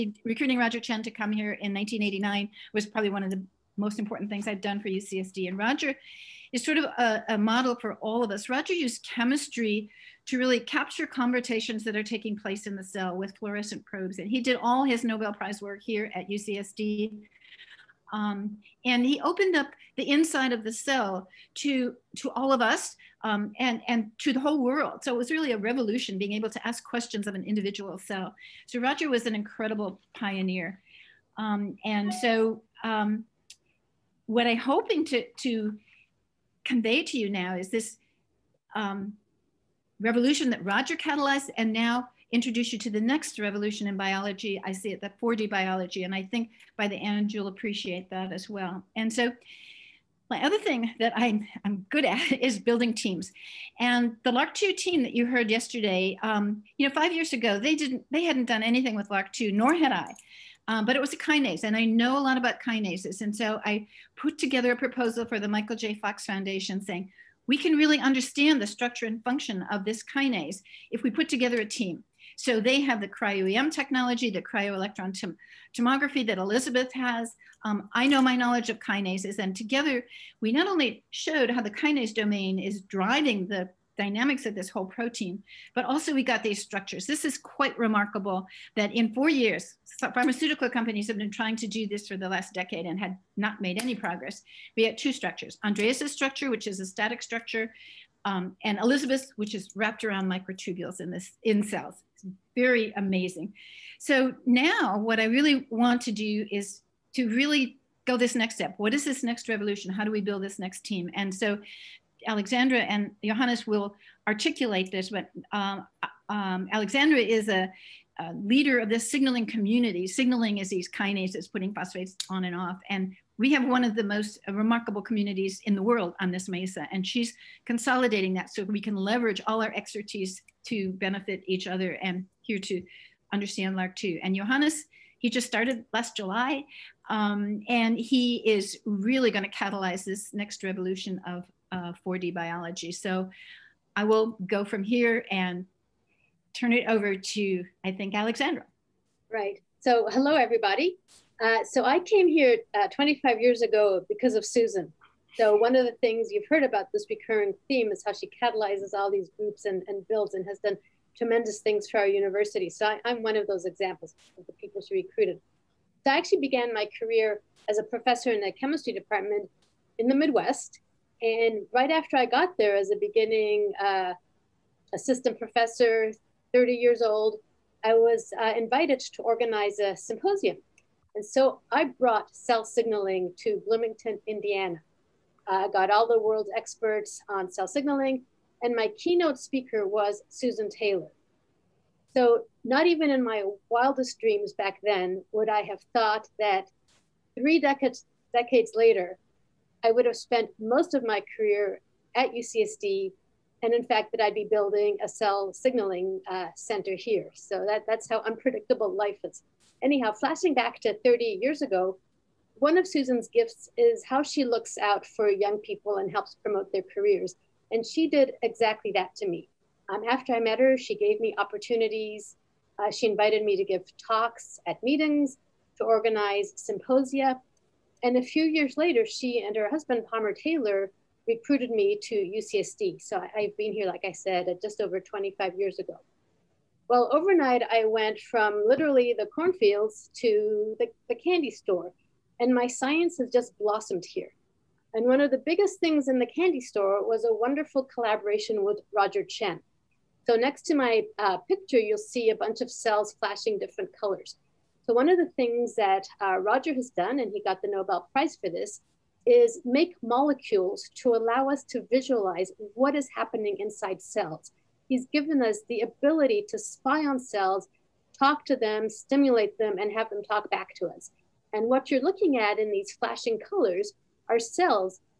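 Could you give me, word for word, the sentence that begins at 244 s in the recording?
And one of the biggest things in the candy store was a wonderful collaboration with Roger Tsien.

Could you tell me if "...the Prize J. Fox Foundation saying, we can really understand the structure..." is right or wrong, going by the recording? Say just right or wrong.
wrong.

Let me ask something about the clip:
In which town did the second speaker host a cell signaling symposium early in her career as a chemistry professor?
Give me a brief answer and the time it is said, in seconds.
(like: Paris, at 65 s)
Bloomington, Indiana, at 183 s.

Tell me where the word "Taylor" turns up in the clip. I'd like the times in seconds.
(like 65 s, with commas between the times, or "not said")
190 s, 230 s.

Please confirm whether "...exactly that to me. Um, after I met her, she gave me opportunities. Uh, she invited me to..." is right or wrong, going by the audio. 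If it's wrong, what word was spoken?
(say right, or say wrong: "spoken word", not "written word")
right.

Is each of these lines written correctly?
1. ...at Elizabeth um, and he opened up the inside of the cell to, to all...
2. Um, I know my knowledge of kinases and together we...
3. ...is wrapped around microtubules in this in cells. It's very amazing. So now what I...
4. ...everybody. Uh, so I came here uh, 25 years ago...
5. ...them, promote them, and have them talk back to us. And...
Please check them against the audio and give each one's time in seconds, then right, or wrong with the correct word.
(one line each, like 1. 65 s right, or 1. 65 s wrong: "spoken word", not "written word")
1. 16 s wrong: "UCSD", not "Elizabeth"
2. 77 s right
3. 99 s right
4. 150 s right
5. 268 s wrong: "stimulate", not "promote".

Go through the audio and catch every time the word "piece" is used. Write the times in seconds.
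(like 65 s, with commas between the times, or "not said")
not said.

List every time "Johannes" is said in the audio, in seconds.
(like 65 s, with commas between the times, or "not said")
113 s, 134 s.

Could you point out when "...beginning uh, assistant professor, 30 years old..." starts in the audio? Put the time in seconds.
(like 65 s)
173 s.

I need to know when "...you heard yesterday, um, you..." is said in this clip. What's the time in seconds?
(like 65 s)
55 s.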